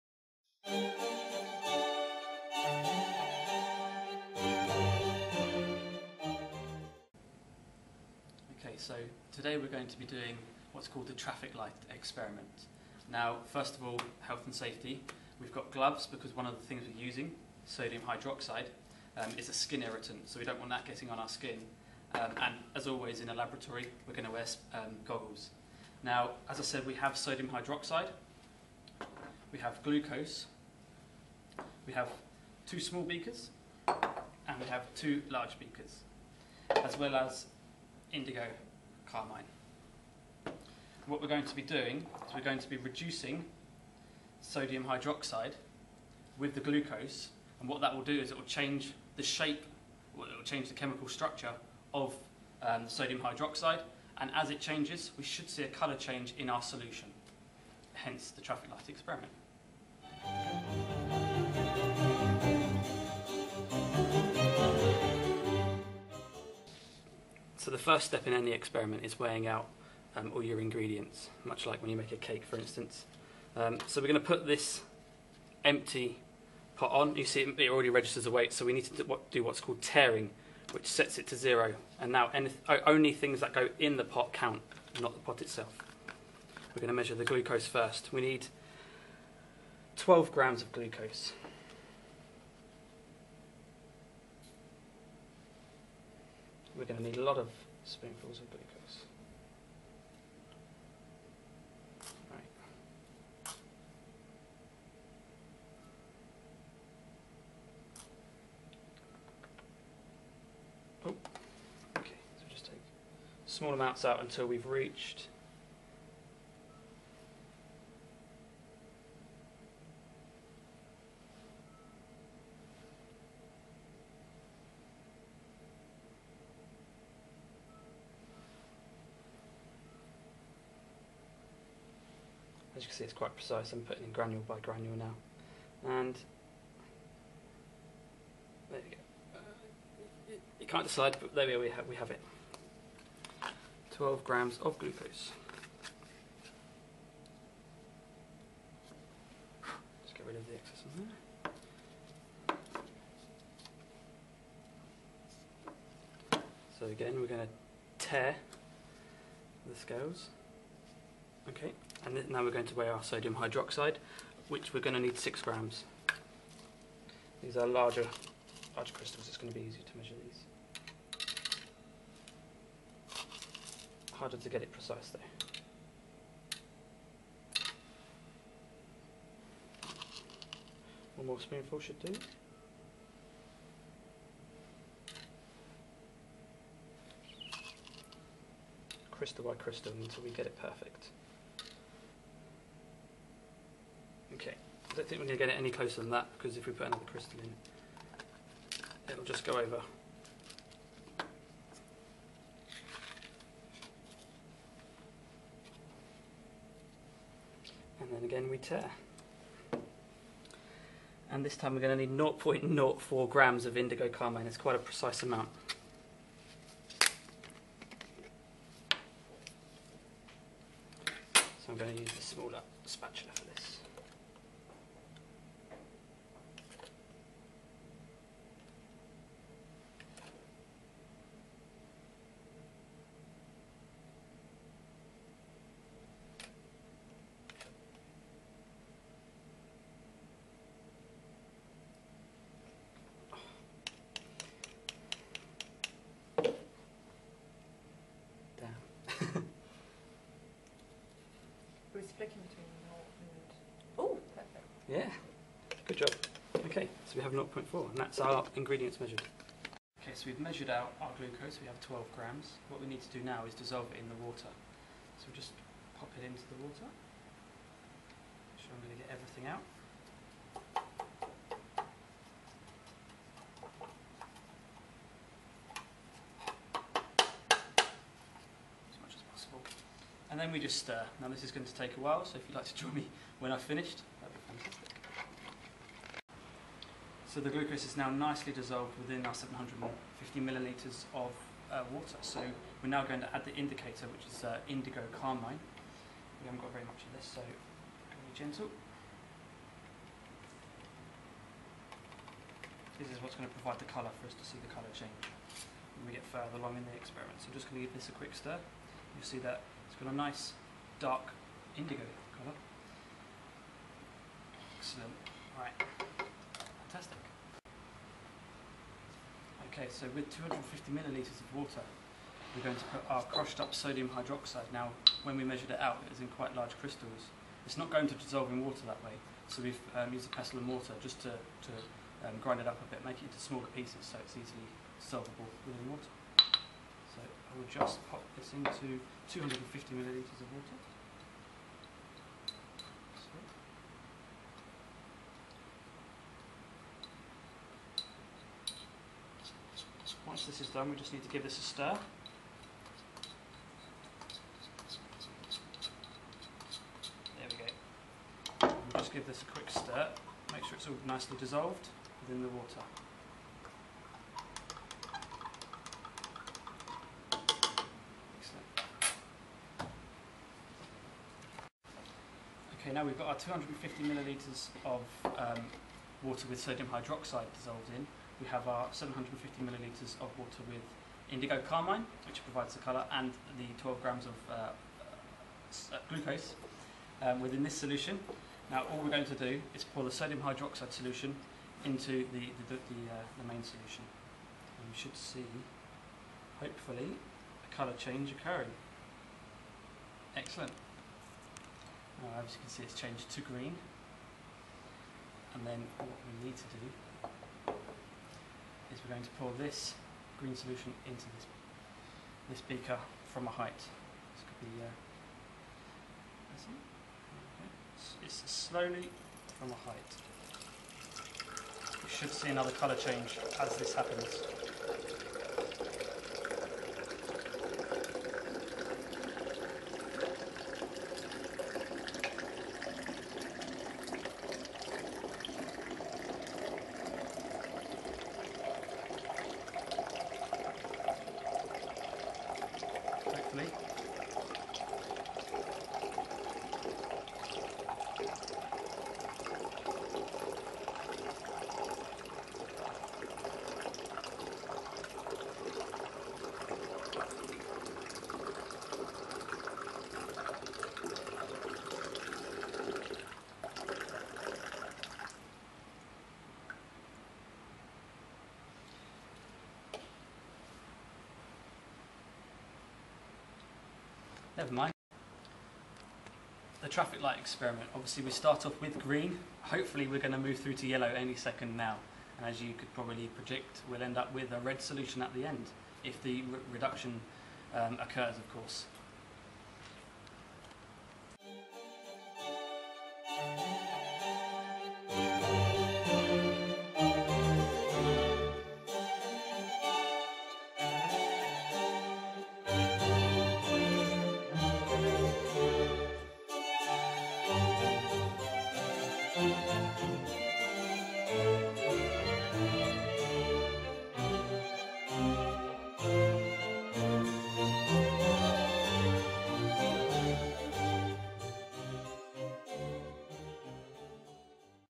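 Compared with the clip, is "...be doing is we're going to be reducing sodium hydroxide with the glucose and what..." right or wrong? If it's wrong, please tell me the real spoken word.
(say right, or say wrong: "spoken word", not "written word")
right.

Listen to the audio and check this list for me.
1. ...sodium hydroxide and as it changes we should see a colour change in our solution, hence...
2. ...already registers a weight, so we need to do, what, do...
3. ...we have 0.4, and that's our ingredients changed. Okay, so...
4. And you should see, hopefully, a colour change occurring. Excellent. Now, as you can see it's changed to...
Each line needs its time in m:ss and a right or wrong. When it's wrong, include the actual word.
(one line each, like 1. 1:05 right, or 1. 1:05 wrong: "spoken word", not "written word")
1. 0:52 right
2. 1:17 right
3. 4:17 wrong: "measured", not "changed"
4. 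6:34 right.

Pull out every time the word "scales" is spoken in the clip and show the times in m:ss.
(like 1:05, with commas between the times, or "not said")
2:39.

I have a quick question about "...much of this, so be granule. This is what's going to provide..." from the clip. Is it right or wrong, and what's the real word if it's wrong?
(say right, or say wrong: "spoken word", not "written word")
wrong: "gentle", not "granule".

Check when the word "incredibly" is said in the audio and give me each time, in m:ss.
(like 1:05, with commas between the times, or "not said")
not said.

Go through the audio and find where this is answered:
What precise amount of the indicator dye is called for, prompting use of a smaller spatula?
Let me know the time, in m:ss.
3:32.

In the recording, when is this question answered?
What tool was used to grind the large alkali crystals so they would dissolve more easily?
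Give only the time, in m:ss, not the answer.
5:30.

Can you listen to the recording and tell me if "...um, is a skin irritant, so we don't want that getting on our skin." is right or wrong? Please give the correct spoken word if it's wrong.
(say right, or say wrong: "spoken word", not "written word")
right.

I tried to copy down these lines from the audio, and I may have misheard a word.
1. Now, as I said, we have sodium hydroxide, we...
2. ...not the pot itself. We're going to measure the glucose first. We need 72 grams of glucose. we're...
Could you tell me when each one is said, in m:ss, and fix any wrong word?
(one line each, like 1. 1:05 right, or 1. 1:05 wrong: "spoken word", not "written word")
1. 0:26 right
2. 1:24 wrong: "12", not "72".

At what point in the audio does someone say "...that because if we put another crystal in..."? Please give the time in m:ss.
3:16.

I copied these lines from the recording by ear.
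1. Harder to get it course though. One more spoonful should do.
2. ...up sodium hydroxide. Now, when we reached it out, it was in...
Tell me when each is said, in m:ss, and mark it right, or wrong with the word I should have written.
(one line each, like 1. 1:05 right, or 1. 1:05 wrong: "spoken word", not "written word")
1. 2:54 wrong: "precise", not "course"
2. 5:23 wrong: "measured", not "reached".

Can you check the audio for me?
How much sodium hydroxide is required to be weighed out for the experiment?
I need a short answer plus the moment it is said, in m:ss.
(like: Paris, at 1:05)
6 grams, at 2:45.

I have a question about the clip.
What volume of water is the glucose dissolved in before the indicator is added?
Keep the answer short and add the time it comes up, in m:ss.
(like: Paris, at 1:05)
750 millilitres, at 4:49.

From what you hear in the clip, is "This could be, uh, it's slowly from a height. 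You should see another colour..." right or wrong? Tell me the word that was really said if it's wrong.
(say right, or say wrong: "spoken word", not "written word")
right.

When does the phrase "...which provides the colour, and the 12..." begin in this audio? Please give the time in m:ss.
6:22.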